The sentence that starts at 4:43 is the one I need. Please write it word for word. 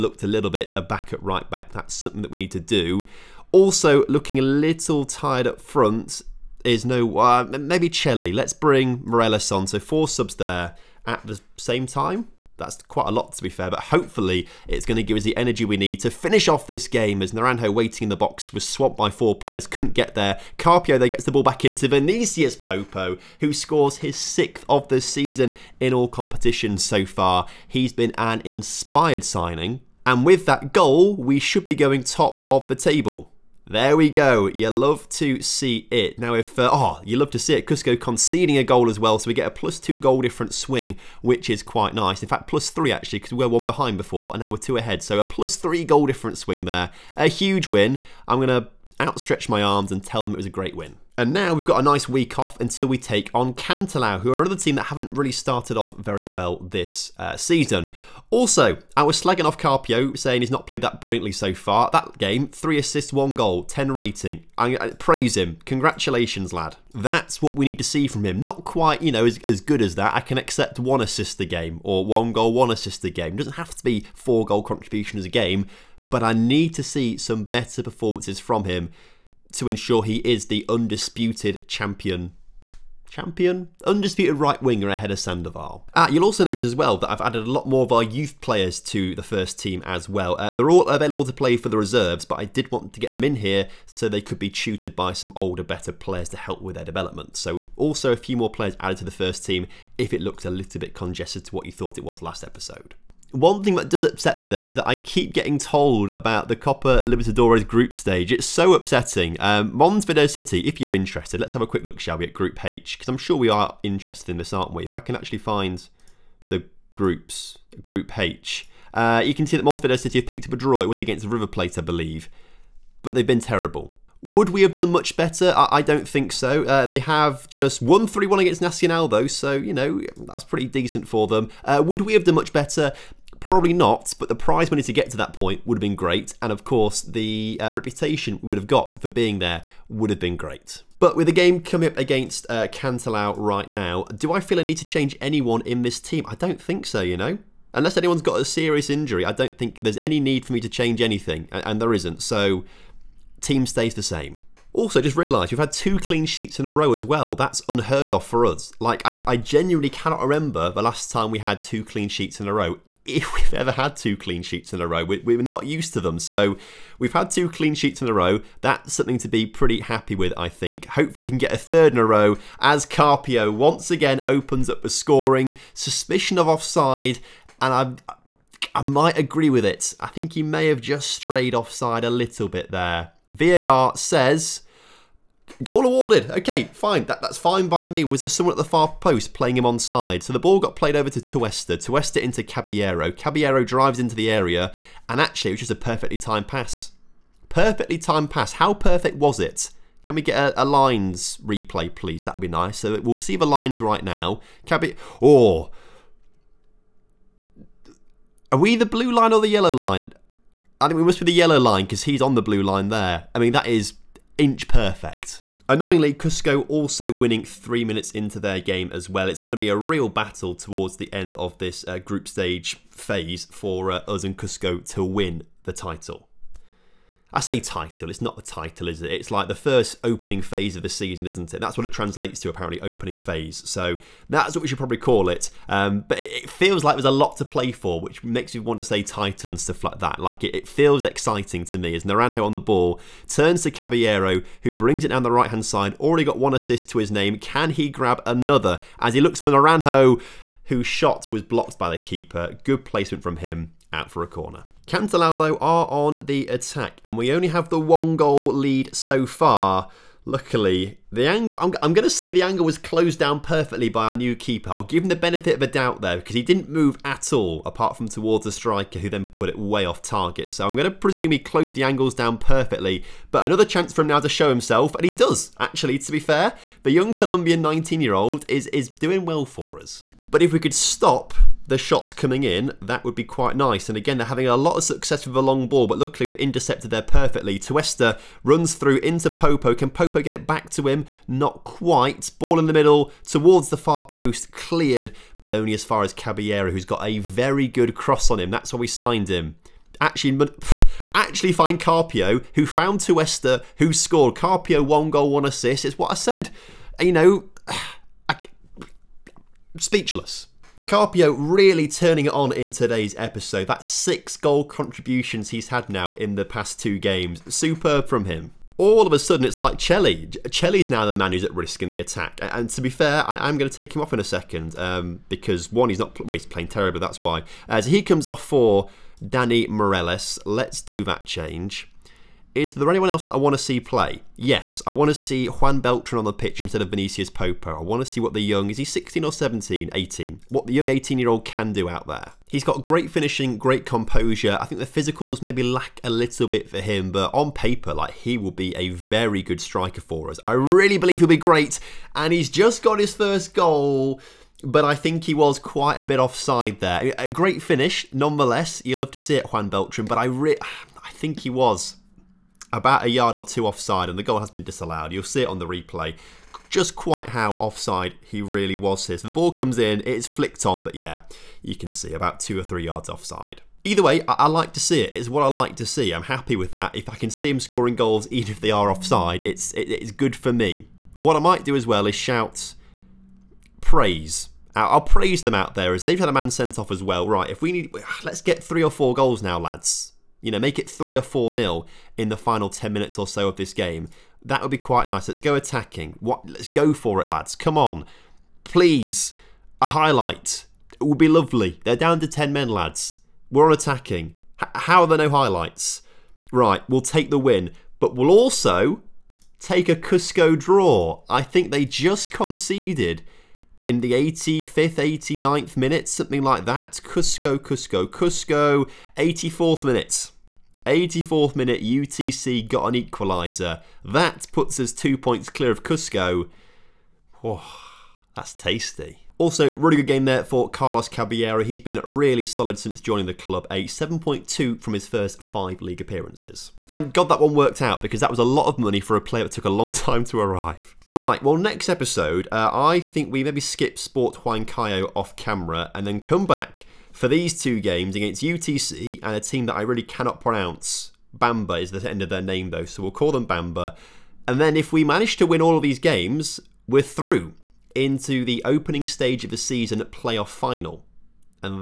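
And again, they're having a lot of success with the long ball, but luckily we intercepted there perfectly.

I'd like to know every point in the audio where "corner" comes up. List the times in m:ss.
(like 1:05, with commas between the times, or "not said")
4:14.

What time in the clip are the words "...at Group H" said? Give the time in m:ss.
1:52.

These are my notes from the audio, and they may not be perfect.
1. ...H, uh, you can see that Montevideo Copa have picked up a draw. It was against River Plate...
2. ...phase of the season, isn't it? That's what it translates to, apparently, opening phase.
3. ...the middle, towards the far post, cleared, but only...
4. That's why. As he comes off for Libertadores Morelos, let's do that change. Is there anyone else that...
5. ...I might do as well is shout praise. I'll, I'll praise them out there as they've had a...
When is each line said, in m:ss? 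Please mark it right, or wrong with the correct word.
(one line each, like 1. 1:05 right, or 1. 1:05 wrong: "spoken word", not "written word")
1. 1:58 wrong: "City", not "Copa"
2. 3:50 right
3. 4:52 right
4. 5:27 wrong: "Danny", not "Libertadores"
5. 6:21 right.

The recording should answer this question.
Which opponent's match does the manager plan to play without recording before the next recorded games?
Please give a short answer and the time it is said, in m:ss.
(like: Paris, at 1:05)
Sport Huancayo, at 7:23.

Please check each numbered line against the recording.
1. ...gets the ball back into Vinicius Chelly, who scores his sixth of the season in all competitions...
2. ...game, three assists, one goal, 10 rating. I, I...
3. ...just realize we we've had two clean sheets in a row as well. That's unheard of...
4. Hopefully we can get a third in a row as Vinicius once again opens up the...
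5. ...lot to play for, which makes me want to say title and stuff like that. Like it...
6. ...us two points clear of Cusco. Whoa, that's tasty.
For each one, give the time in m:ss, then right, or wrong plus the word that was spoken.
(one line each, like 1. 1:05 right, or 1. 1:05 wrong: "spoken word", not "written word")
1. 0:21 wrong: "Popo", not "Chelly"
2. 1:02 right
3. 2:34 right
4. 2:50 wrong: "Carpio", not "Vinicius"
5. 3:57 right
6. 7:04 right.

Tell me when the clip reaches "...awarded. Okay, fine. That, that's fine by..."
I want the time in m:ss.
3:05.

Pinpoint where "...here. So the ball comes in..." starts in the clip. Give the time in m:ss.
6:09.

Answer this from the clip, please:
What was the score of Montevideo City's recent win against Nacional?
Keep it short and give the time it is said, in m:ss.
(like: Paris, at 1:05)
3-1, at 2:08.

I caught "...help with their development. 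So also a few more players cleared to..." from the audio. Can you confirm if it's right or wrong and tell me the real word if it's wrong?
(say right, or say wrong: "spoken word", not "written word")
wrong: "added", not "cleared".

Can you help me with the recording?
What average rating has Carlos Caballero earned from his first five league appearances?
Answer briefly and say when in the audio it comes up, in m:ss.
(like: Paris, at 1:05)
7.2, at 7:13.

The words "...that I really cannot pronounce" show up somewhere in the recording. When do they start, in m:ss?
7:29.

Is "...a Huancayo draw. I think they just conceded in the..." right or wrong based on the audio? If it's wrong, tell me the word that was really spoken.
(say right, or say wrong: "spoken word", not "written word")
wrong: "Cusco", not "Huancayo".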